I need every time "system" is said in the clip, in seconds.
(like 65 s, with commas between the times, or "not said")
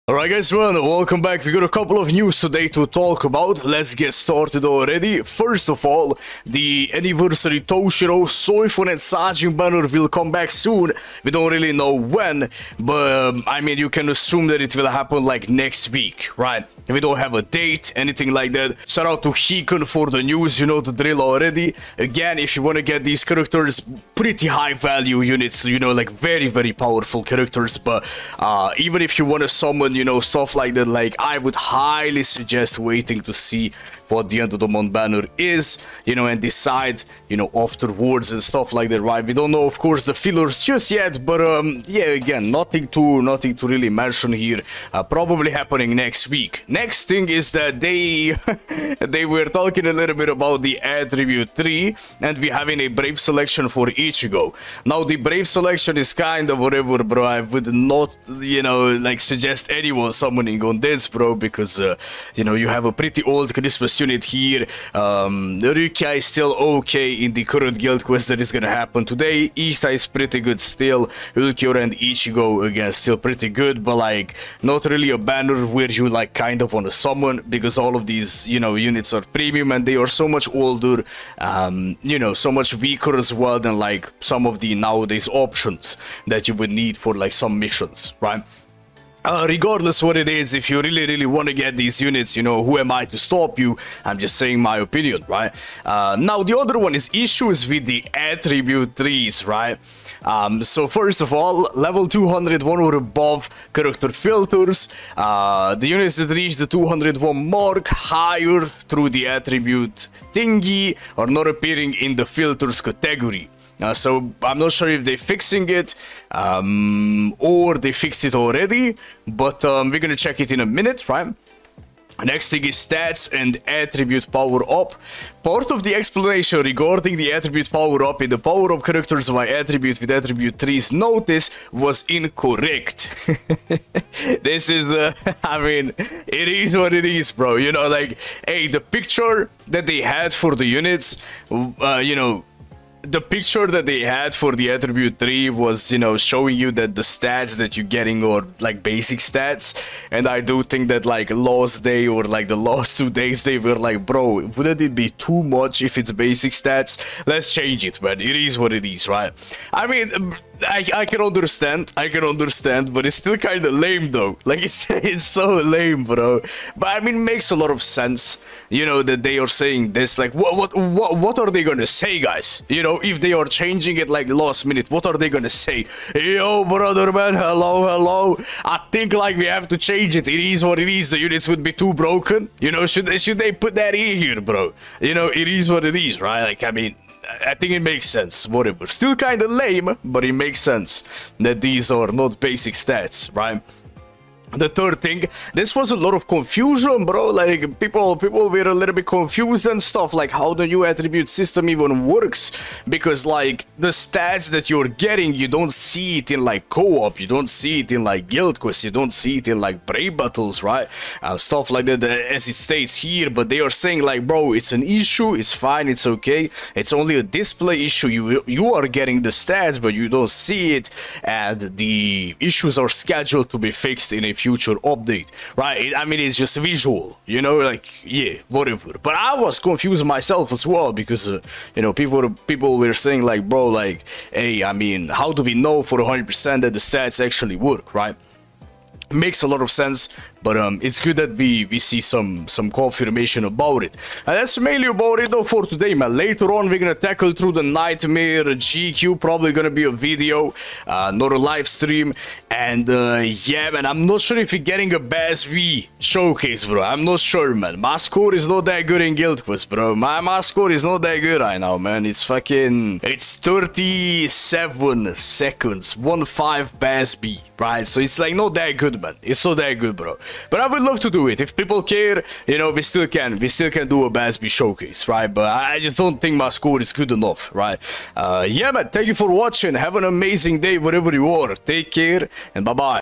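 201 s.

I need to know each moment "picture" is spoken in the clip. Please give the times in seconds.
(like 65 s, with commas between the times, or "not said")
138 s, 143 s.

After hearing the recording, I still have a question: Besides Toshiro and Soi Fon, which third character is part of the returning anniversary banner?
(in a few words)
Sajin.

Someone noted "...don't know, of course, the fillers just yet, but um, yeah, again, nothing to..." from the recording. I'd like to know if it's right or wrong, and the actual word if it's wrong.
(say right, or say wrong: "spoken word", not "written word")
right.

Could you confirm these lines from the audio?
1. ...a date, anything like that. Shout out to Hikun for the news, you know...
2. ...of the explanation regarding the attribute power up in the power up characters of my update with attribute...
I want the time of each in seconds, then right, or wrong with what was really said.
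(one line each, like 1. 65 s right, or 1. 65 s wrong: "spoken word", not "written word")
1. 17 s right
2. 125 s wrong: "attribute", not "update".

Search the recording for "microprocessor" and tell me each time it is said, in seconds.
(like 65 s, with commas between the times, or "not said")
not said.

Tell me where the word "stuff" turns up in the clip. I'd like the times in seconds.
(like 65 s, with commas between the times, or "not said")
30 s, 38 s, 199 s, 211 s.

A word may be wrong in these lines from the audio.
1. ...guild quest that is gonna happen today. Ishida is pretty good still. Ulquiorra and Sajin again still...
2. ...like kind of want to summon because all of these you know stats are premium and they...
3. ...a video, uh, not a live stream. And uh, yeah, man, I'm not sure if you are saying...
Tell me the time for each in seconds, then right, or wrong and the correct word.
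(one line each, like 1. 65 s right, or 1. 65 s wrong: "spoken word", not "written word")
1. 67 s wrong: "Ichigo", not "Sajin"
2. 76 s wrong: "units", not "stats"
3. 249 s wrong: "getting", not "saying".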